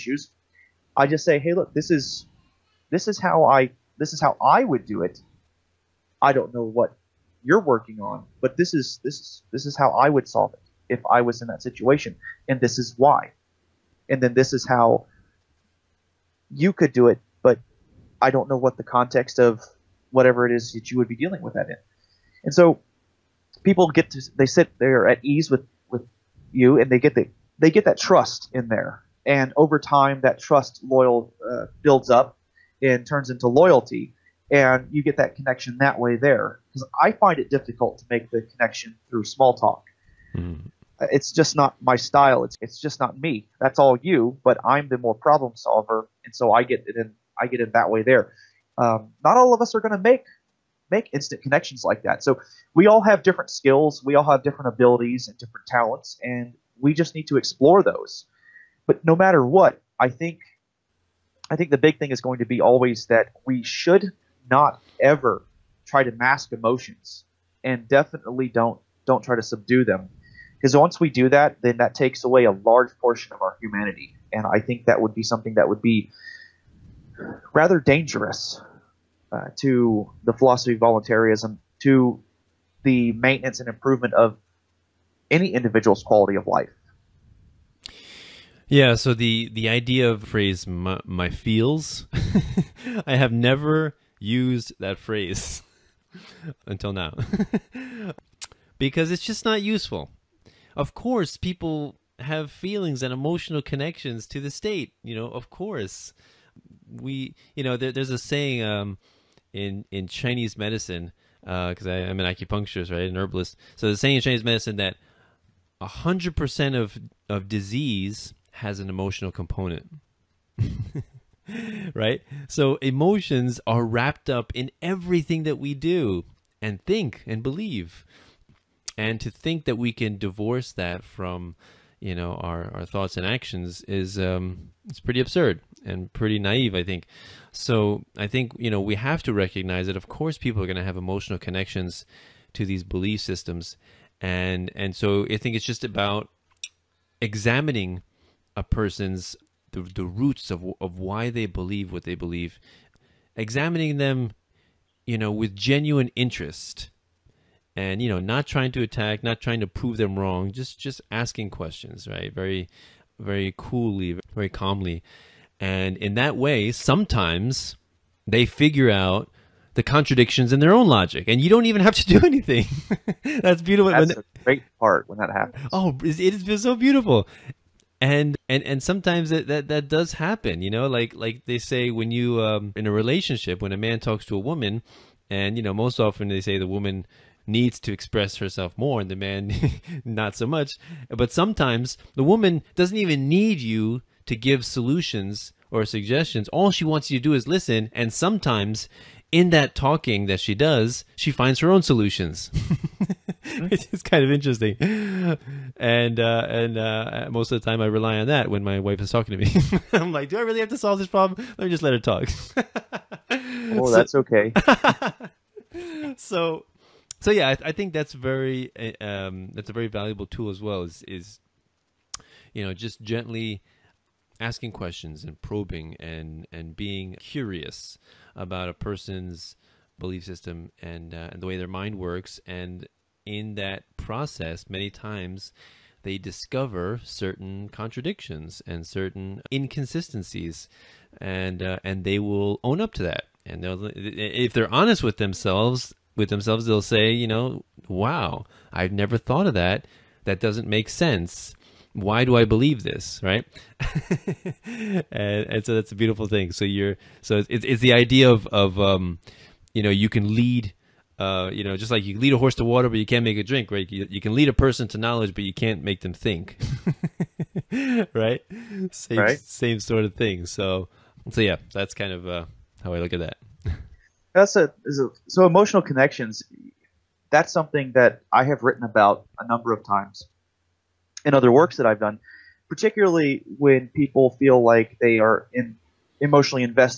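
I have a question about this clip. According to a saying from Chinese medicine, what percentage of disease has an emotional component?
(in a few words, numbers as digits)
100%.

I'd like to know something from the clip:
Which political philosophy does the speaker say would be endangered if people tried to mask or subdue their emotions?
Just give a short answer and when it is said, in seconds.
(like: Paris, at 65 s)
voluntaryism, at 80 s.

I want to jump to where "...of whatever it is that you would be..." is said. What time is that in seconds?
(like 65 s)
19 s.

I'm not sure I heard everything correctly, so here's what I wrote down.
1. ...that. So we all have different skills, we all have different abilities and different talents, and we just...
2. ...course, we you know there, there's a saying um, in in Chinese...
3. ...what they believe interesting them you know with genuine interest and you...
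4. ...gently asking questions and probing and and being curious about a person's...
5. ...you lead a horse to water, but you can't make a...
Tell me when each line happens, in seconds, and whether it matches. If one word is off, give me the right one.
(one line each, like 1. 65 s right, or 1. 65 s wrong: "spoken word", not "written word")
1. 52 s right
2. 105 s right
3. 151 s wrong: "examining", not "interesting"
4. 223 s right
5. 262 s right.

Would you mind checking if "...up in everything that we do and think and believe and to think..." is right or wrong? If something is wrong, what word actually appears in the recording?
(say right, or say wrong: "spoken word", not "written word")
right.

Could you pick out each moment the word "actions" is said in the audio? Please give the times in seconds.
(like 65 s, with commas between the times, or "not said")
133 s.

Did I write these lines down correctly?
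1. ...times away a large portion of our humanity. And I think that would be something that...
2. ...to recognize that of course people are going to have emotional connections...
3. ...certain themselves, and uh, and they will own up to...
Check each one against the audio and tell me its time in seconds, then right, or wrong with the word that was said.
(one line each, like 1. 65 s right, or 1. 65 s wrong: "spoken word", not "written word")
1. 71 s wrong: "takes", not "times"
2. 139 s right
3. 238 s wrong: "inconsistencies", not "themselves".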